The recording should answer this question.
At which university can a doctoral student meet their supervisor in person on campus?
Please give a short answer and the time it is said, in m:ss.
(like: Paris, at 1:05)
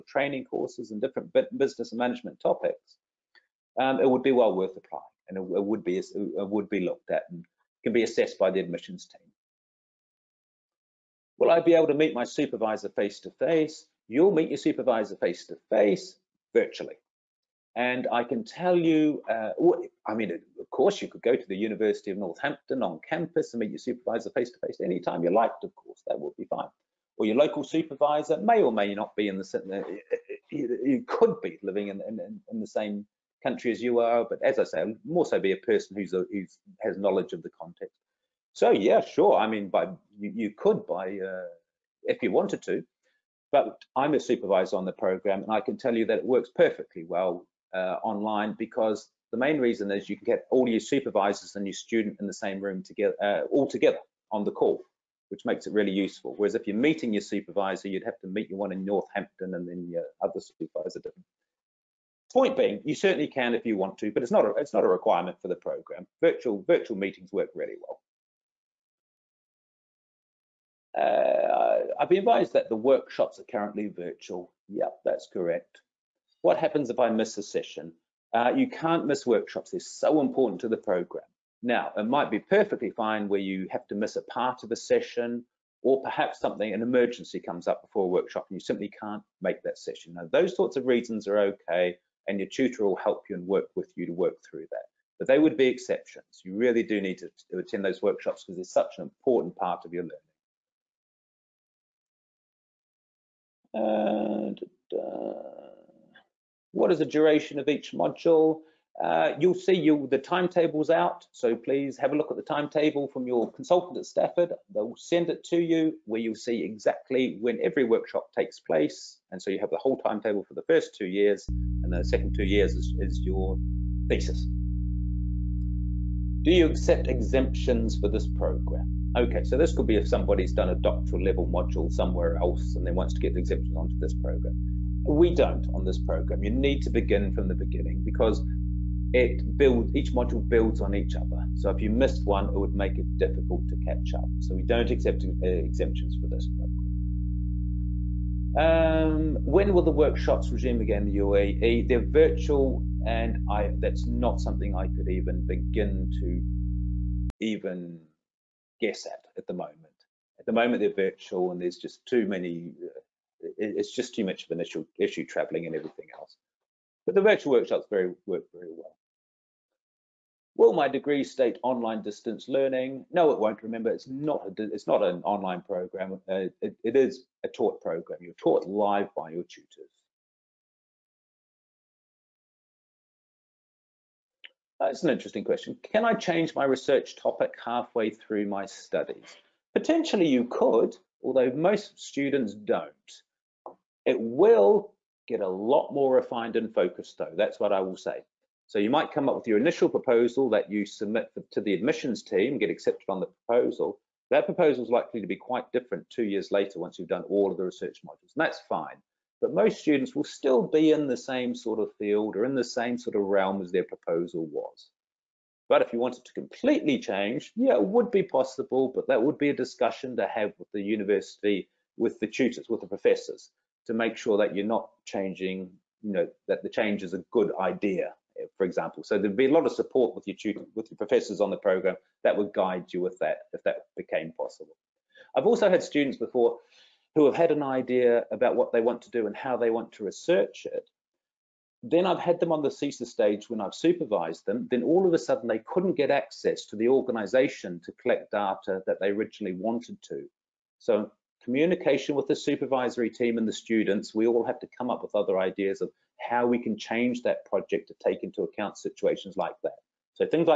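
University of Northampton, at 0:21.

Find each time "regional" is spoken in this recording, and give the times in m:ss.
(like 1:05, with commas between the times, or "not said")
not said.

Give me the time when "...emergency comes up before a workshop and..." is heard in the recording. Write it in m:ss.
1:26.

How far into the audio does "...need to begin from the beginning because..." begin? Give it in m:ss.
2:16.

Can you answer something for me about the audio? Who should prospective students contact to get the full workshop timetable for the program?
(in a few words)
Consultant at Stafford.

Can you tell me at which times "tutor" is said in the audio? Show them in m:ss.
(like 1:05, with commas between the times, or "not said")
1:32, 2:59, 3:42, 3:50.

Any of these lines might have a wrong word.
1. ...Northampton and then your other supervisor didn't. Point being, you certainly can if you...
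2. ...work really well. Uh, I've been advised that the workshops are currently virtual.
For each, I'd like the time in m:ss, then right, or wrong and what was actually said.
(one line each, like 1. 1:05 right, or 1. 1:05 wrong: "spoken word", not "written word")
1. 0:58 right
2. 1:07 right.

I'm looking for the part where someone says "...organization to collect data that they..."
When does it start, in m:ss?
4:06.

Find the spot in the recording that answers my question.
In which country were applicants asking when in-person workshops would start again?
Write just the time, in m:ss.
2:31.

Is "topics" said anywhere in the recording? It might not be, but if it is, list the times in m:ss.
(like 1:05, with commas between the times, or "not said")
0:02, 3:07.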